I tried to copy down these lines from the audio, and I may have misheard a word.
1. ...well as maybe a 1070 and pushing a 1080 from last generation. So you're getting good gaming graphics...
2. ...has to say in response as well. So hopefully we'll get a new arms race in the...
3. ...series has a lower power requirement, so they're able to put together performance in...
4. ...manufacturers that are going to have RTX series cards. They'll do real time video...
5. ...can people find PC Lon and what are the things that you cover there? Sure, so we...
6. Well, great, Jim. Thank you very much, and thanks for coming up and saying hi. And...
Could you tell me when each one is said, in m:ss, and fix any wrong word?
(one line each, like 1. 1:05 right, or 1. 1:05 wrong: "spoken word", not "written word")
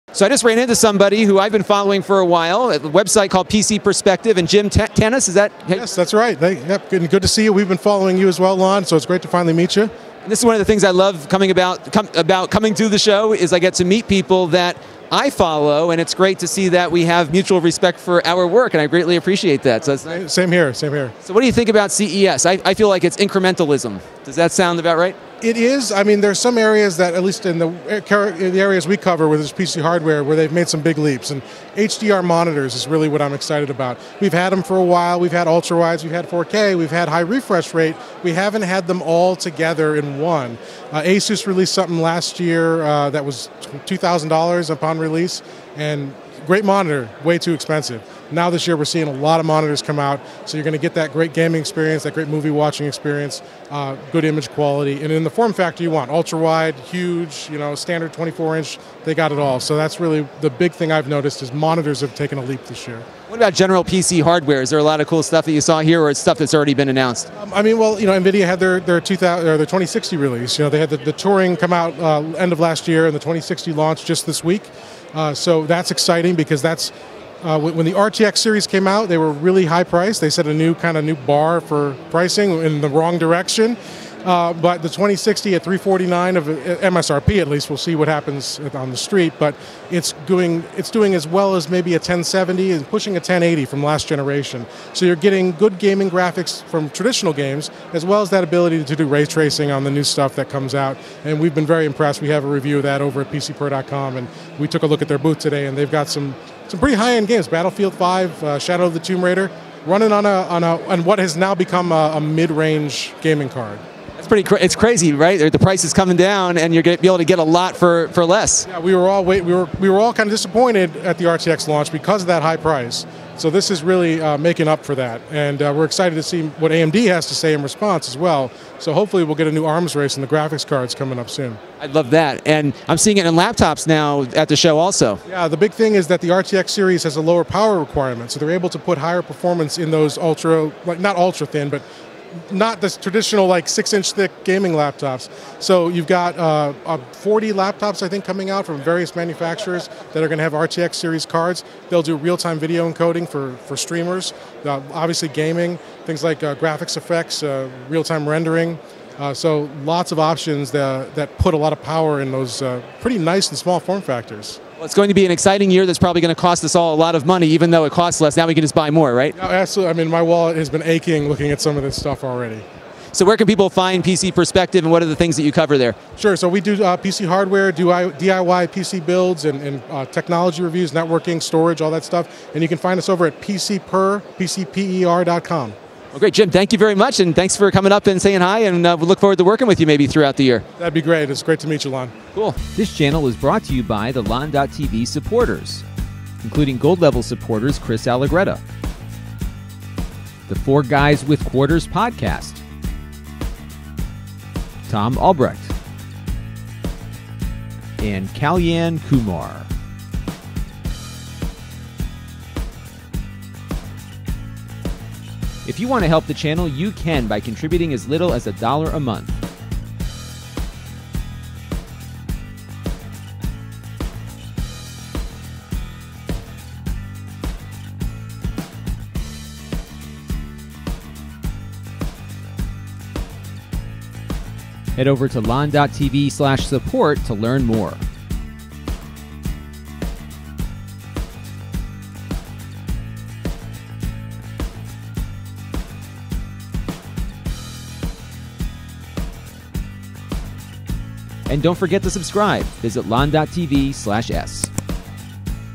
1. 1:31 right
2. 2:07 right
3. 2:16 wrong: "higher", not "together"
4. 2:29 right
5. 2:53 wrong: "Perspective", not "Lon"
6. 3:06 right.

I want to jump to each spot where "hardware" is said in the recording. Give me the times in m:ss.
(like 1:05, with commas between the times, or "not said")
0:29, 1:04, 2:57.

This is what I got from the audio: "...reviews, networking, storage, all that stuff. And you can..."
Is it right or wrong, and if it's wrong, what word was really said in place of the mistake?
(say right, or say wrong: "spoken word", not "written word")
right.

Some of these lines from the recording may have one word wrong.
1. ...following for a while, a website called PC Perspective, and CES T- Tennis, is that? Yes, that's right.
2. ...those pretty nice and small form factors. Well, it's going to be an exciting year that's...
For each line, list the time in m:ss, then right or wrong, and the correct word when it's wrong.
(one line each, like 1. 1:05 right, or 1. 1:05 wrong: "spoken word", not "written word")
1. 0:01 wrong: "Jim", not "CES"
2. 2:42 right.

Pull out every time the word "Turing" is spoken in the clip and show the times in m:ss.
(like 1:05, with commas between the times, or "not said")
1:11.